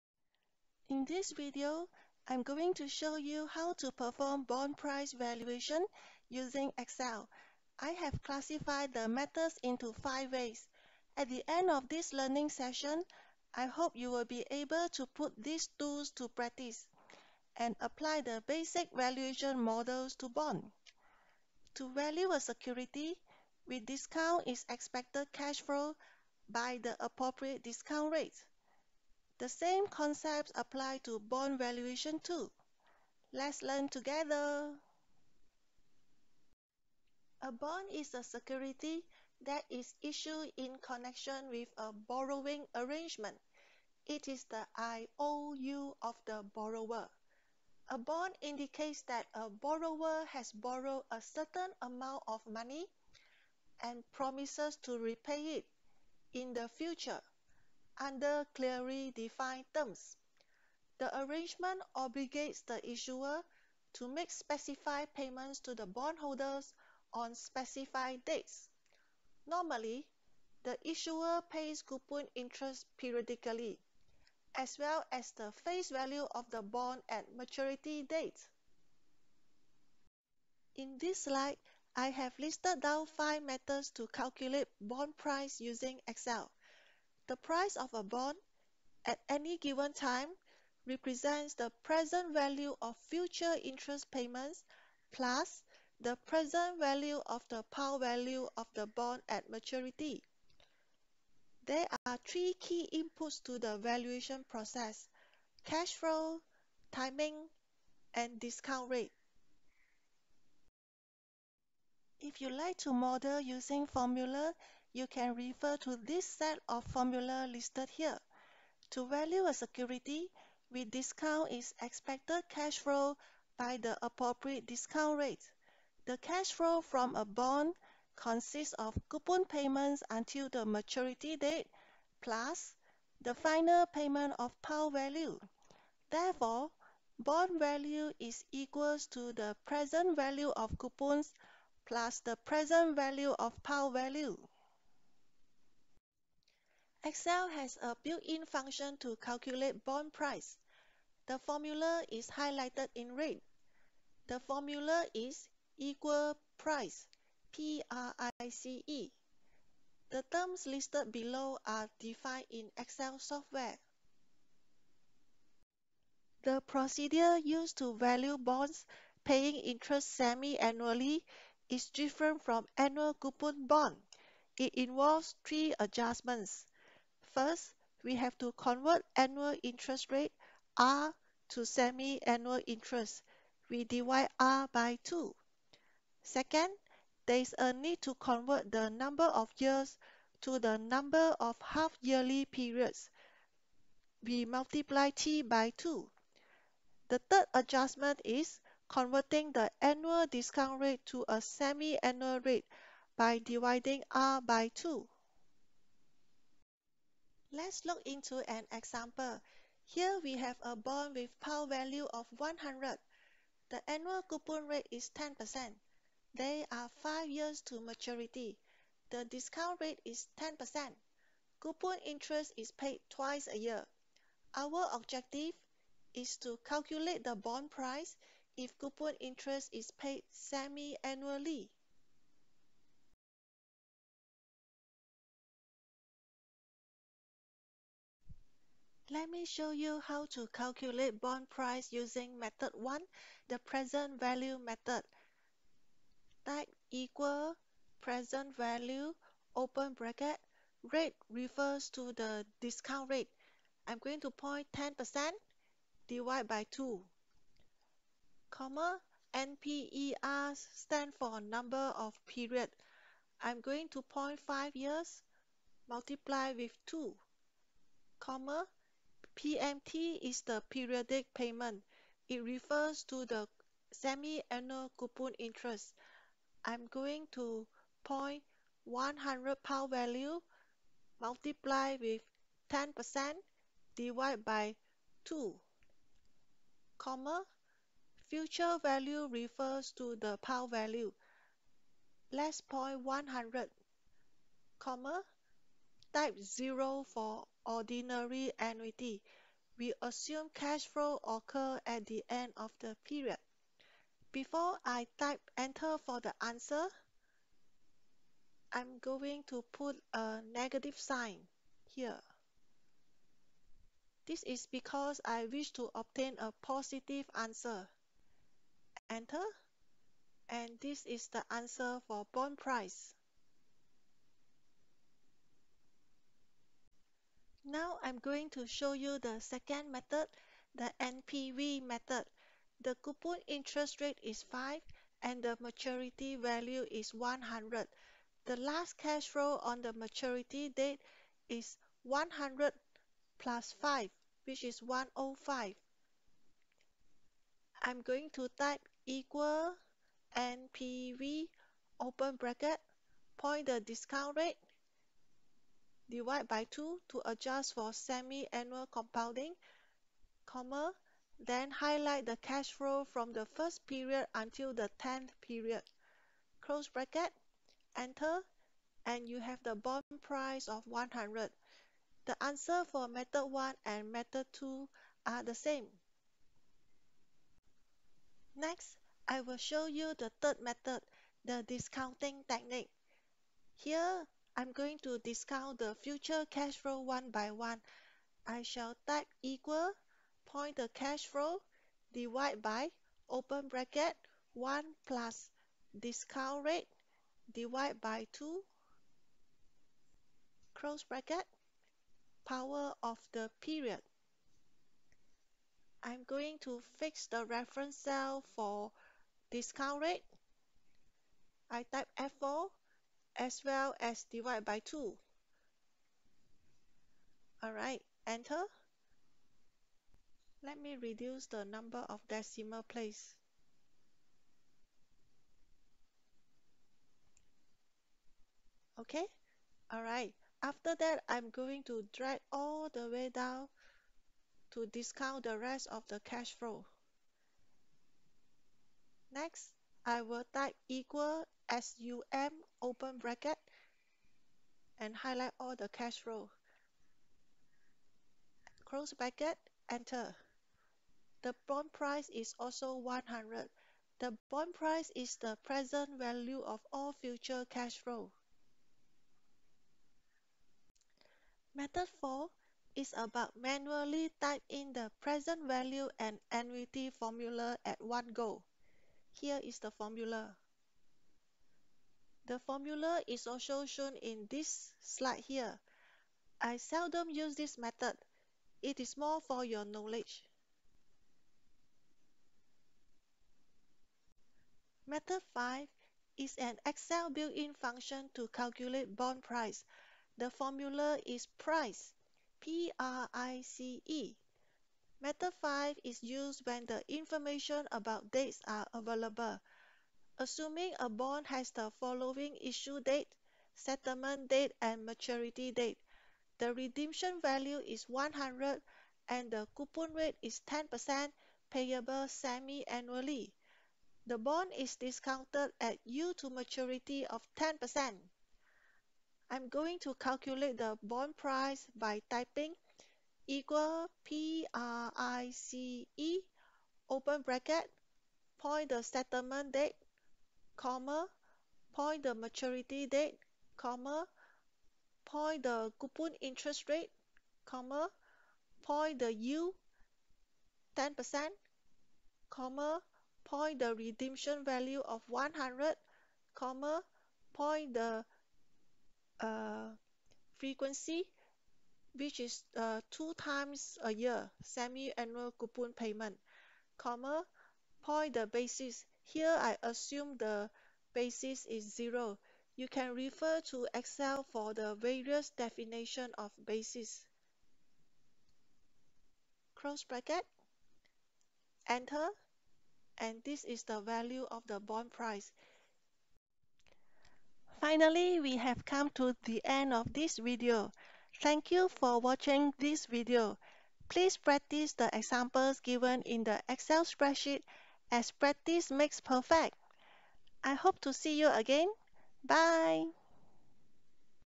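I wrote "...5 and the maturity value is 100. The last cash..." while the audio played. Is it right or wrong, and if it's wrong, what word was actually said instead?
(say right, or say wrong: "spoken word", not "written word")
right.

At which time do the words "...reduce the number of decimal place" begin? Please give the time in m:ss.
7:01.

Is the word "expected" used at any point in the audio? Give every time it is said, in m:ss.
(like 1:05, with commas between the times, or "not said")
0:24, 2:01.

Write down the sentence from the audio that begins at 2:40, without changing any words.
The terms listed below are defined in Excel software.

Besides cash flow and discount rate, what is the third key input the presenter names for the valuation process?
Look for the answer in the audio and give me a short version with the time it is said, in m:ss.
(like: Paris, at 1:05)
Timing, at 1:46.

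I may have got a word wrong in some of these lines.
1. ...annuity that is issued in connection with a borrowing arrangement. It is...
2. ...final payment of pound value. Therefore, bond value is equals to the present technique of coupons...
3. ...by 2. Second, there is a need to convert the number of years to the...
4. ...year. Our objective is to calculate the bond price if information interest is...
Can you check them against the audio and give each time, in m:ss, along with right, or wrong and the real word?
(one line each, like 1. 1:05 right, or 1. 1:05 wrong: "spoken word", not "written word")
1. 0:38 wrong: "security", not "annuity"
2. 2:13 wrong: "value", not "technique"
3. 3:04 right
4. 3:43 wrong: "coupon", not "information".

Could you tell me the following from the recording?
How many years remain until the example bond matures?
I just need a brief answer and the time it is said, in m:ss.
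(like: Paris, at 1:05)
5, at 3:37.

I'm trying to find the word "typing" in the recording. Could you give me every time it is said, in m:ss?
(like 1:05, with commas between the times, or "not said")
8:42.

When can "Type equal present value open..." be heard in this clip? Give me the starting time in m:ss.
4:06.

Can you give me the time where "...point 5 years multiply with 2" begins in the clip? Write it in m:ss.
4:24.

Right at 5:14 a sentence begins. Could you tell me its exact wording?
This is because I wish to obtain a positive answer.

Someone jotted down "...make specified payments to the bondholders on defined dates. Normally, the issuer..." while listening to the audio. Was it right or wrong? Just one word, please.
wrong.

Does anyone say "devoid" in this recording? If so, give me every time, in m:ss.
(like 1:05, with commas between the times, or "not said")
not said.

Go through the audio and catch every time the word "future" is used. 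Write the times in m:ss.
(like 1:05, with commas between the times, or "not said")
0:56, 1:32, 4:48, 6:25, 7:37.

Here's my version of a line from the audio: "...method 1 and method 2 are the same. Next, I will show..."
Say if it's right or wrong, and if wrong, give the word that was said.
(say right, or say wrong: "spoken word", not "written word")
right.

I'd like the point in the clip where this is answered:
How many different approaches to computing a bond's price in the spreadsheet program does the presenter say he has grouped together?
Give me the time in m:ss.
0:09.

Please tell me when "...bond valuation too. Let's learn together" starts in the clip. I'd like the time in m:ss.
0:31.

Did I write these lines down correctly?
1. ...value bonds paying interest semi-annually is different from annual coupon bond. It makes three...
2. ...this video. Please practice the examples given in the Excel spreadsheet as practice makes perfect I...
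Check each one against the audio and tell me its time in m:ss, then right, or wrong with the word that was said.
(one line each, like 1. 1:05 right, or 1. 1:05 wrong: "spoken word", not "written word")
1. 2:47 wrong: "involves", not "makes"
2. 9:42 right.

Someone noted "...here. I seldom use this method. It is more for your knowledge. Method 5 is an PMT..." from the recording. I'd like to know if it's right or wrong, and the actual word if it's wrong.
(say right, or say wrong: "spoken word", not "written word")
wrong: "Excel", not "PMT".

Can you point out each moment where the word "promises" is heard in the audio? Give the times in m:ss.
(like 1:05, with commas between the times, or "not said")
0:54.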